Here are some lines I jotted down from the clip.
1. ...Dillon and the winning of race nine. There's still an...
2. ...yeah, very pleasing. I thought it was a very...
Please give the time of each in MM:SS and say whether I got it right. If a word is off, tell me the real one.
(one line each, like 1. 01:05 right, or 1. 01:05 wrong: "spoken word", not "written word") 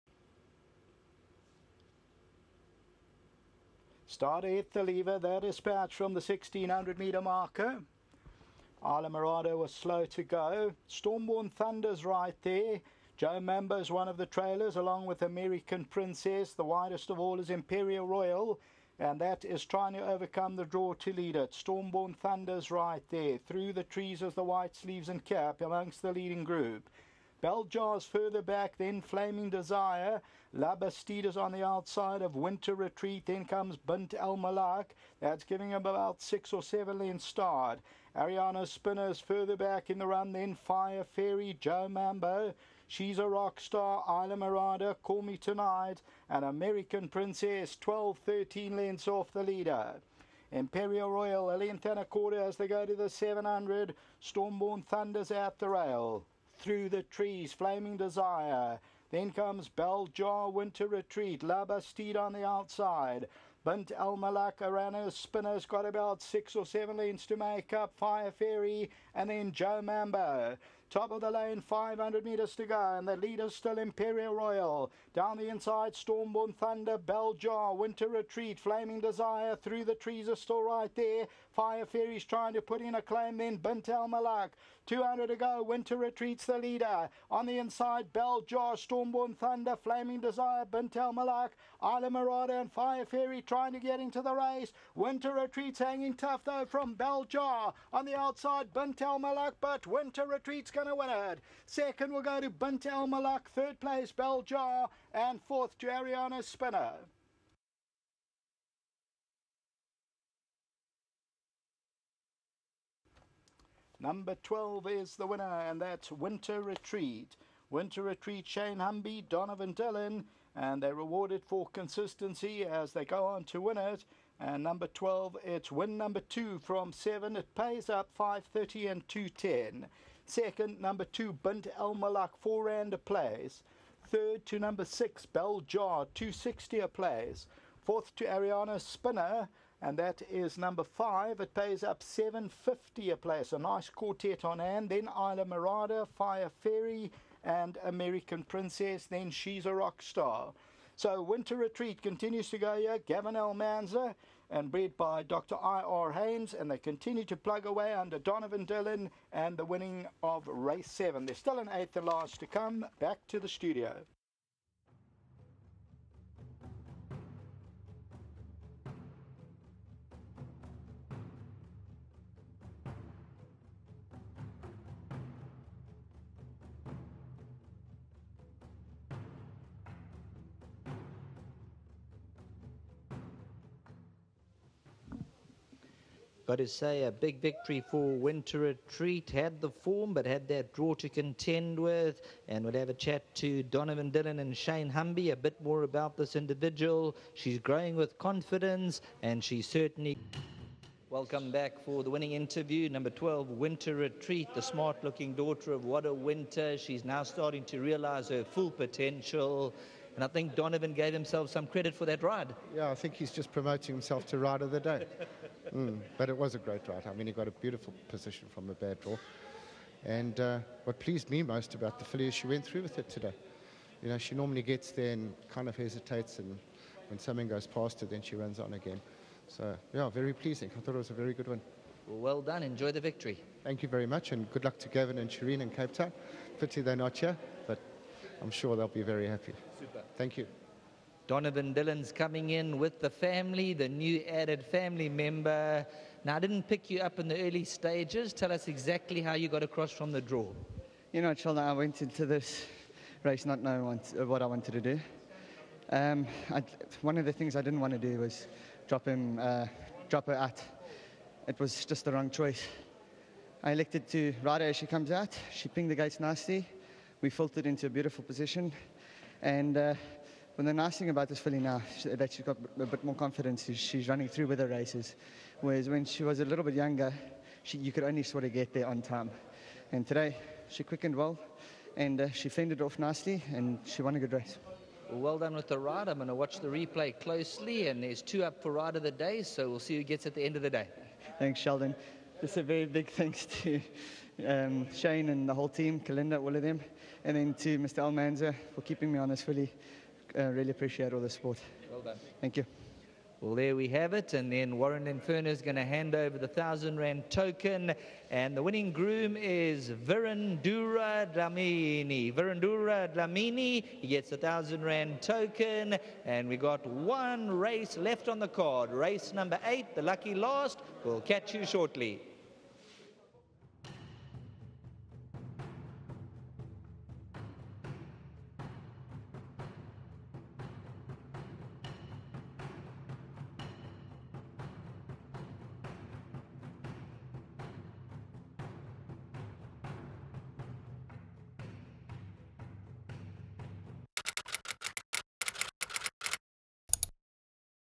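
1. 02:38 wrong: "seven", not "nine"
2. 03:49 right.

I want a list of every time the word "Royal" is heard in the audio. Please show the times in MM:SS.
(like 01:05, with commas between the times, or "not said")
00:18, 00:51, 01:14.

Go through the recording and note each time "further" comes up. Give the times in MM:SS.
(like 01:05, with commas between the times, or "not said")
00:28, 00:39.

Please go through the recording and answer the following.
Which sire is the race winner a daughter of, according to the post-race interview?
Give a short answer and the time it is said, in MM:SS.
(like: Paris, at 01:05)
What A Winter, at 03:25.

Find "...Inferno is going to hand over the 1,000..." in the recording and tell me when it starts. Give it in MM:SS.
05:05.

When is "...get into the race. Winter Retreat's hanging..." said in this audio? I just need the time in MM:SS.
01:33.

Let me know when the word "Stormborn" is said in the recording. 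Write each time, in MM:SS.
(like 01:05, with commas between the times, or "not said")
00:10, 00:21, 00:54, 01:15, 01:28.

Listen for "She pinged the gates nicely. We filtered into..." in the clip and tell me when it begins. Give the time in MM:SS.
04:25.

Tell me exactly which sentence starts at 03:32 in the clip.
Yeah, I think he's just promoting himself to Rider of the Day.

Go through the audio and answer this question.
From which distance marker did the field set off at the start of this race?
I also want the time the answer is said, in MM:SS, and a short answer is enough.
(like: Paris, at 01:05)
1600 meters, at 00:06.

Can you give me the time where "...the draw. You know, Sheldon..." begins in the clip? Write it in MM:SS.
04:10.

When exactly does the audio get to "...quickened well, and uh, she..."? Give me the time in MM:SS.
04:40.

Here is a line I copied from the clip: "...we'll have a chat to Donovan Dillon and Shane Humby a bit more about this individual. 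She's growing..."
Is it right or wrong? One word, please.
right.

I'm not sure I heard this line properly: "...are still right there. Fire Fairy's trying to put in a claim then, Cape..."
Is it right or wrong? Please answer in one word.
wrong.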